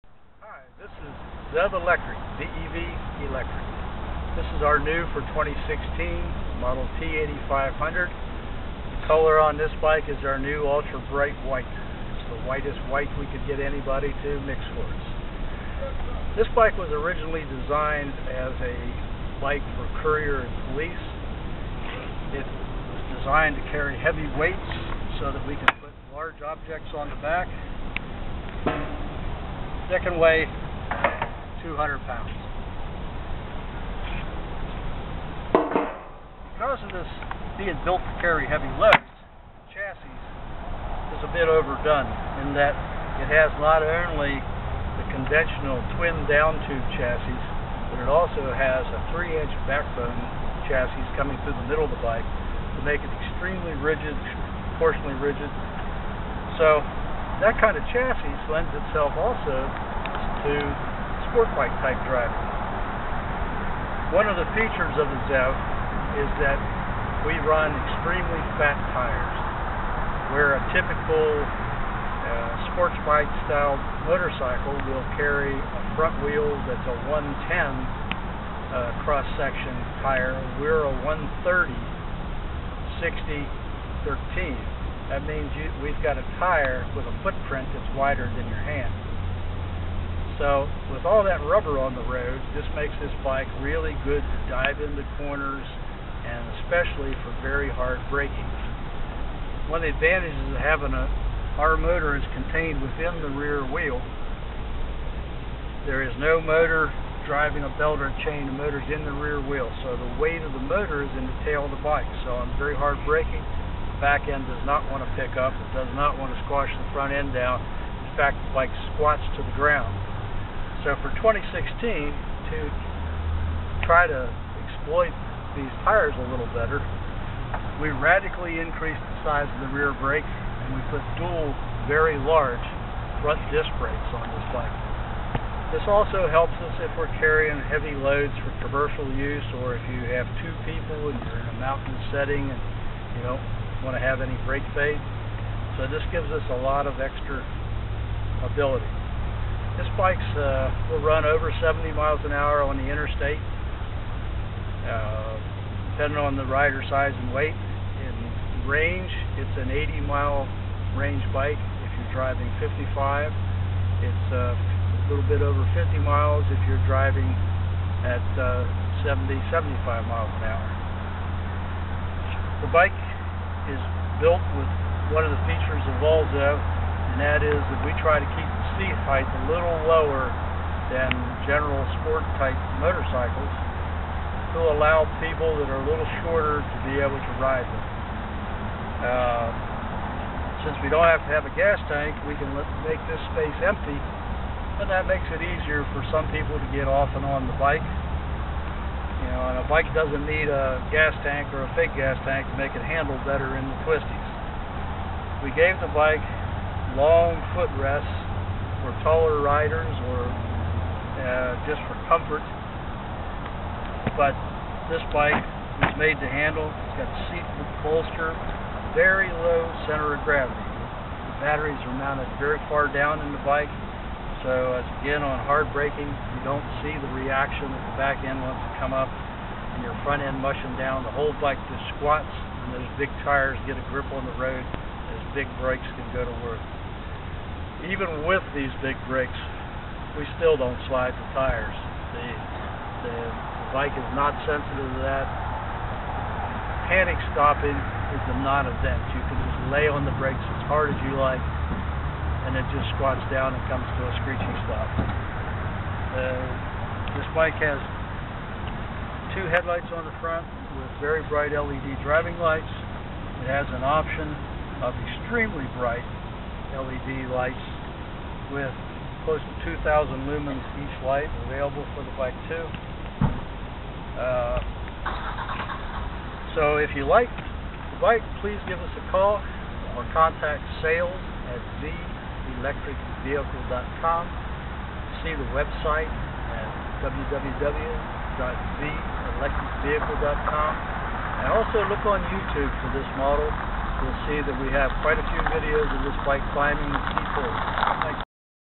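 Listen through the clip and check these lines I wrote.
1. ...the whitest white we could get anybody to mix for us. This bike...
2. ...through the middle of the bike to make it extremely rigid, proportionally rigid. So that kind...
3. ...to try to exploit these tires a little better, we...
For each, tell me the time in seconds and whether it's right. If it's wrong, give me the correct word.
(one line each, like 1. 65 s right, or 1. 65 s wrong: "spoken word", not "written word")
1. 12 s right
2. 51 s right
3. 121 s right.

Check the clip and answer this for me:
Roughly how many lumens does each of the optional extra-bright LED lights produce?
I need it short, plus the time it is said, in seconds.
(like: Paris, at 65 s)
2,000 lumens, at 269 s.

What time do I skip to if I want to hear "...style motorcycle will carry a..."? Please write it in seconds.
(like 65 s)
73 s.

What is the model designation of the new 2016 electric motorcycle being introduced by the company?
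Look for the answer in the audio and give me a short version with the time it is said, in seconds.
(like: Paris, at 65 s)
T8500, at 6 s.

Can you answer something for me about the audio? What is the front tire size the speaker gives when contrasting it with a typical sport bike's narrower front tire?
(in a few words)
130 60 13.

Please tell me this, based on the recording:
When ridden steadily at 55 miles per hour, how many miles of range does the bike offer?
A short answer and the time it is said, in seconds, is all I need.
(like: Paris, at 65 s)
80 miles, at 159 s.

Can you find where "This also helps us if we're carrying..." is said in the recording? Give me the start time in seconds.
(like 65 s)
135 s.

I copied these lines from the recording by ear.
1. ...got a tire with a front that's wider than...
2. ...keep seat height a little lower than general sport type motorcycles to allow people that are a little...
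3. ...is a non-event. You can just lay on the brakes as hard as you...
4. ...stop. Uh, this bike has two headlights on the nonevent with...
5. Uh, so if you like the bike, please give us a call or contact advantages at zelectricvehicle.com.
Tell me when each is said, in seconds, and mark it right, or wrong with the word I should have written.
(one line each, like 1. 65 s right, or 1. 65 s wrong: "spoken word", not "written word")
1. 86 s wrong: "footprint", not "front"
2. 178 s right
3. 248 s right
4. 254 s wrong: "front", not "nonevent"
5. 274 s wrong: "sales", not "advantages".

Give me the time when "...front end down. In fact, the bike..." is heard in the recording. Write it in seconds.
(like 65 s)
116 s.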